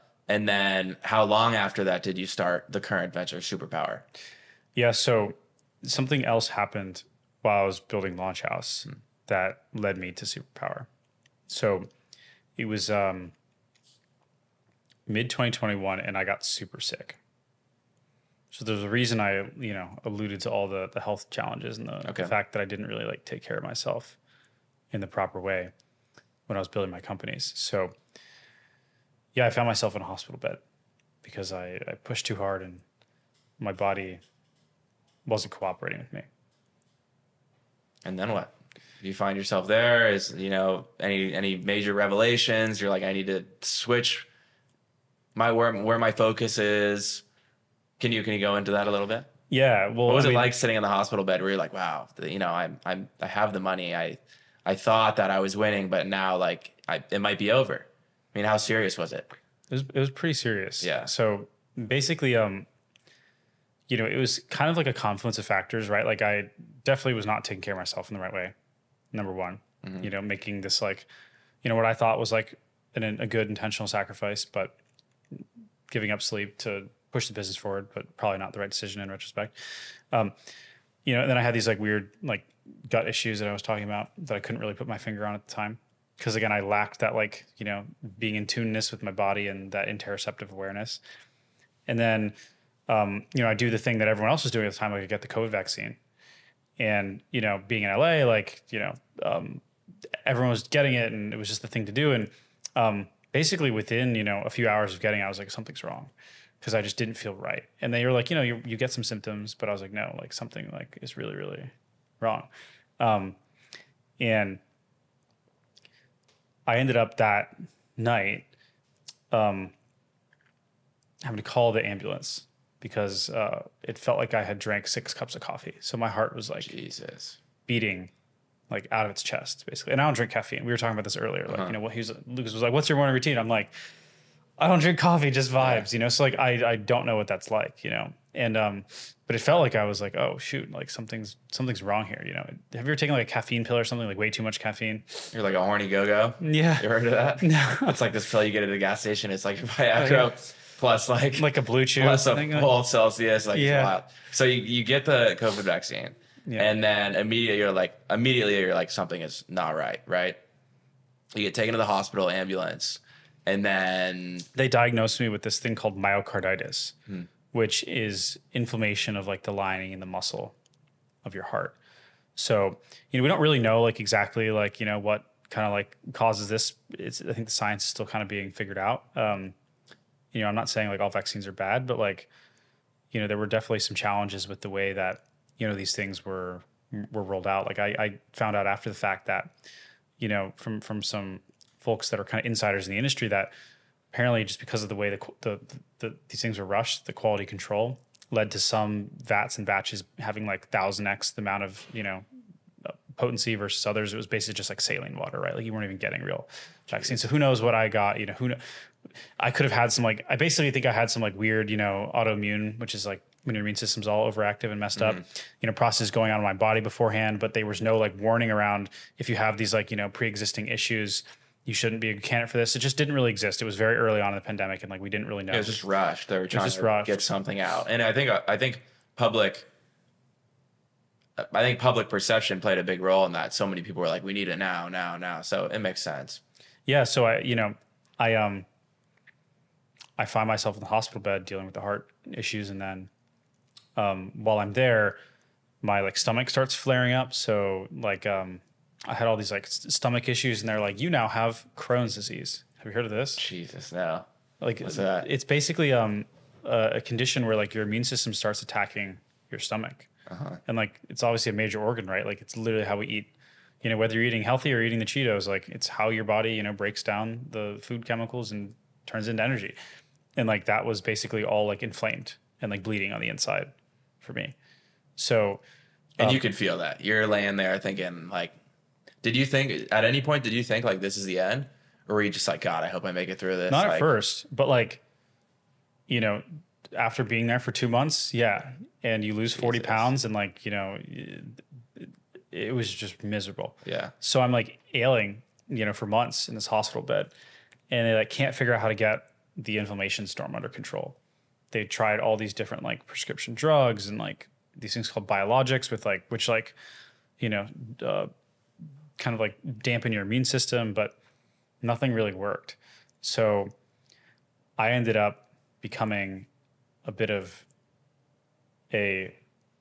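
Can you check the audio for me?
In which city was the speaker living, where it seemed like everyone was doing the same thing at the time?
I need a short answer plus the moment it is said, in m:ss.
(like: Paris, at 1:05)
LA, at 1:37.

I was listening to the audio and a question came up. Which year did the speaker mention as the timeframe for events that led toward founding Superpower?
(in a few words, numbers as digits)
2021.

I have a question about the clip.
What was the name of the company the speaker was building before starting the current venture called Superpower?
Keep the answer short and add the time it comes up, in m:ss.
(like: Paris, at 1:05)
Launch House, at 0:08.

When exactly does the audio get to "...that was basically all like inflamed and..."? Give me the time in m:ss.
4:30.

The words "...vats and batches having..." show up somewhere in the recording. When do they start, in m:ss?
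3:19.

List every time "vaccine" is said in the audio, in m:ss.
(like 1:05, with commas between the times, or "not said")
1:35, 2:35, 3:01, 3:26.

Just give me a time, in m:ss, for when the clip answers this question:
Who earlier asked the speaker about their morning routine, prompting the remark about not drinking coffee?
2:12.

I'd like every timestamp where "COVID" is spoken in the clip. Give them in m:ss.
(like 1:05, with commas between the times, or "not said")
1:35, 2:35.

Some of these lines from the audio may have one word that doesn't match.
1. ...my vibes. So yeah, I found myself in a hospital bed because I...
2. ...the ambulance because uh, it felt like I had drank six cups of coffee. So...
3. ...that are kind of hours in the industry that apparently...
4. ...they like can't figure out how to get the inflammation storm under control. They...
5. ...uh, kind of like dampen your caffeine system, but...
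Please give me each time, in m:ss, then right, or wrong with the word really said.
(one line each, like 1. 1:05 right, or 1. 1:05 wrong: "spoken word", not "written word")
1. 0:26 wrong: "companies", not "vibes"
2. 2:01 right
3. 3:12 wrong: "insiders", not "hours"
4. 4:58 right
5. 5:08 wrong: "immune", not "caffeine".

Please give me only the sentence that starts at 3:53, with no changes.
So many people were like, "We need it now, now, now." So it makes sense.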